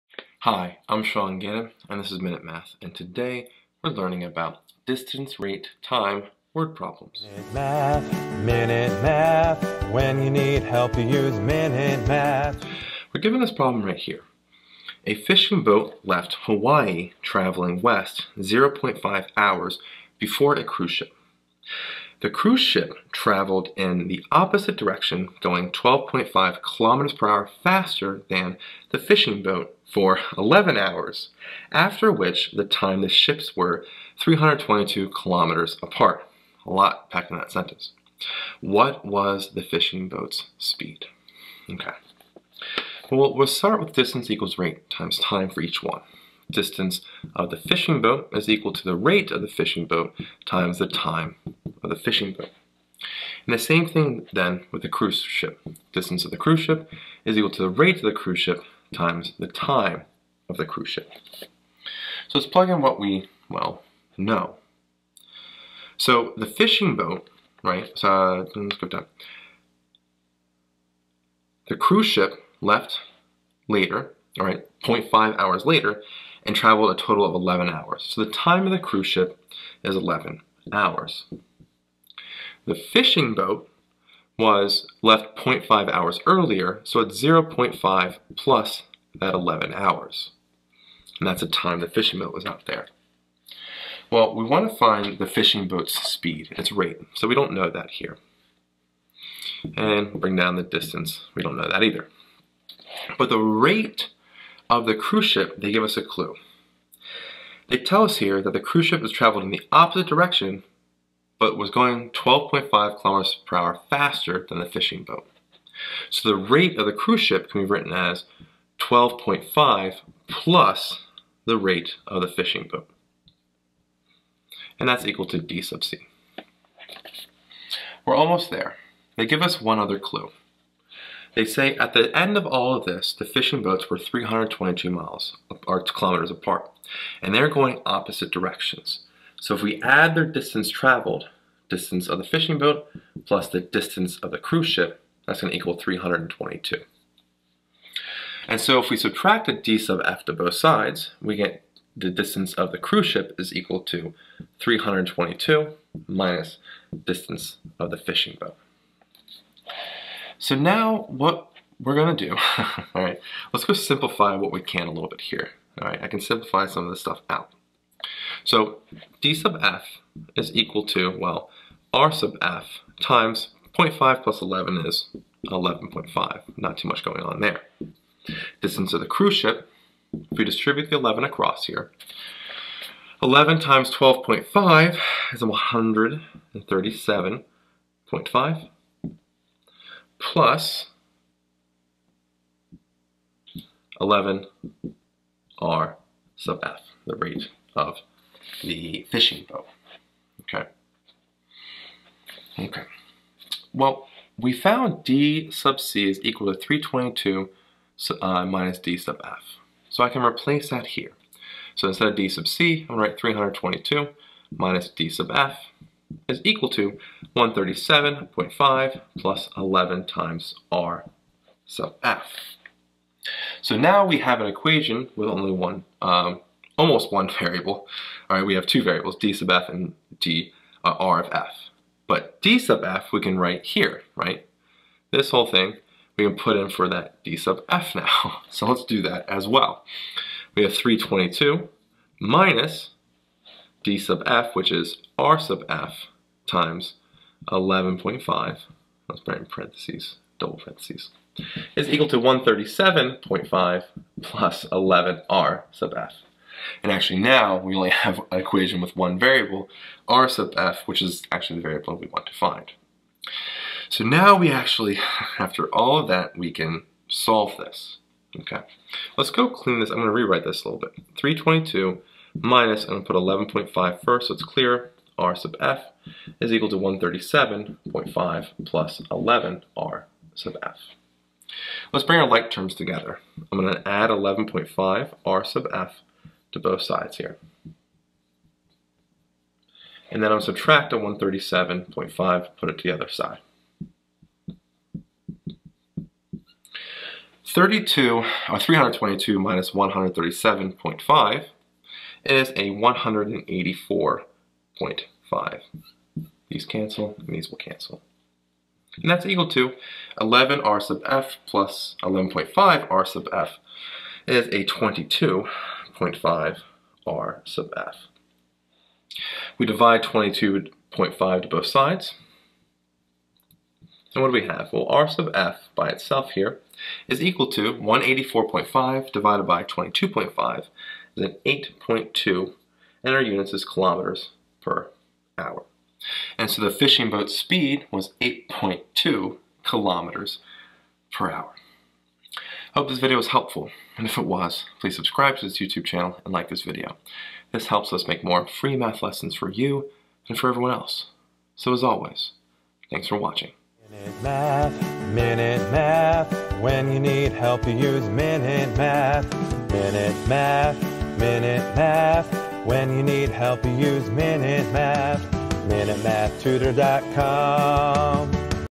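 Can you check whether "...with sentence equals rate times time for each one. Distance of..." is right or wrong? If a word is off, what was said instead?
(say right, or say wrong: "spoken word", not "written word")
wrong: "distance", not "sentence".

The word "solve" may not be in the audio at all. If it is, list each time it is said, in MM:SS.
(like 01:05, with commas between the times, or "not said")
04:27.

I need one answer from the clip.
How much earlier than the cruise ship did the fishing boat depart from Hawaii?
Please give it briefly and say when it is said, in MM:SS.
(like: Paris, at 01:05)
0.5 hours, at 00:18.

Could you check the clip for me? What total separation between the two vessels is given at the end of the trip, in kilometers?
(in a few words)
322.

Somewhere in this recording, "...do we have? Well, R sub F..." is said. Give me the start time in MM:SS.
05:24.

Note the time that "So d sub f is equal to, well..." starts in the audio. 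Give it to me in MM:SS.
02:48.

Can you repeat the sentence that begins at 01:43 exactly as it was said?
But the rate of the cruise ship, they give us a clue.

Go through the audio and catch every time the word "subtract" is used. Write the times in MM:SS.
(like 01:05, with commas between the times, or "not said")
02:28, 04:50.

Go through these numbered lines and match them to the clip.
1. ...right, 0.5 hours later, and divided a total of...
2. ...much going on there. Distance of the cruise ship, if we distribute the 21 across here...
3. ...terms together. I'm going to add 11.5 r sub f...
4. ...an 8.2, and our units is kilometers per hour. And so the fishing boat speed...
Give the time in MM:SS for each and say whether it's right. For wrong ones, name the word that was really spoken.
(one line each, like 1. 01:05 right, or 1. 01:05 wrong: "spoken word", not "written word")
1. 01:14 wrong: "traveled", not "divided"
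2. 02:56 wrong: "11", not "21"
3. 04:42 right
4. 05:31 right.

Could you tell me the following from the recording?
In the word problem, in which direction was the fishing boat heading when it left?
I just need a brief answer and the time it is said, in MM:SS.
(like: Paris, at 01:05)
west, at 00:17.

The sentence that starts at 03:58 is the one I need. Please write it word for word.
So let's do that as well.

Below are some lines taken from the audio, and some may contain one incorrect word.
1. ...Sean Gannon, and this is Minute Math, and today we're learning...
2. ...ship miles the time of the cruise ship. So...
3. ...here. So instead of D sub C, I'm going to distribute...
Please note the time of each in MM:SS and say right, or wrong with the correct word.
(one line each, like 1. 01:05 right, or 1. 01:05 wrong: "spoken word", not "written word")
1. 00:01 right
2. 00:58 wrong: "times", not "miles"
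3. 03:30 wrong: "write", not "distribute".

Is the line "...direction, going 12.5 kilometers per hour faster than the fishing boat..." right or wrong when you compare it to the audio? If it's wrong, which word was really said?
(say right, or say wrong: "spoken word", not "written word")
right.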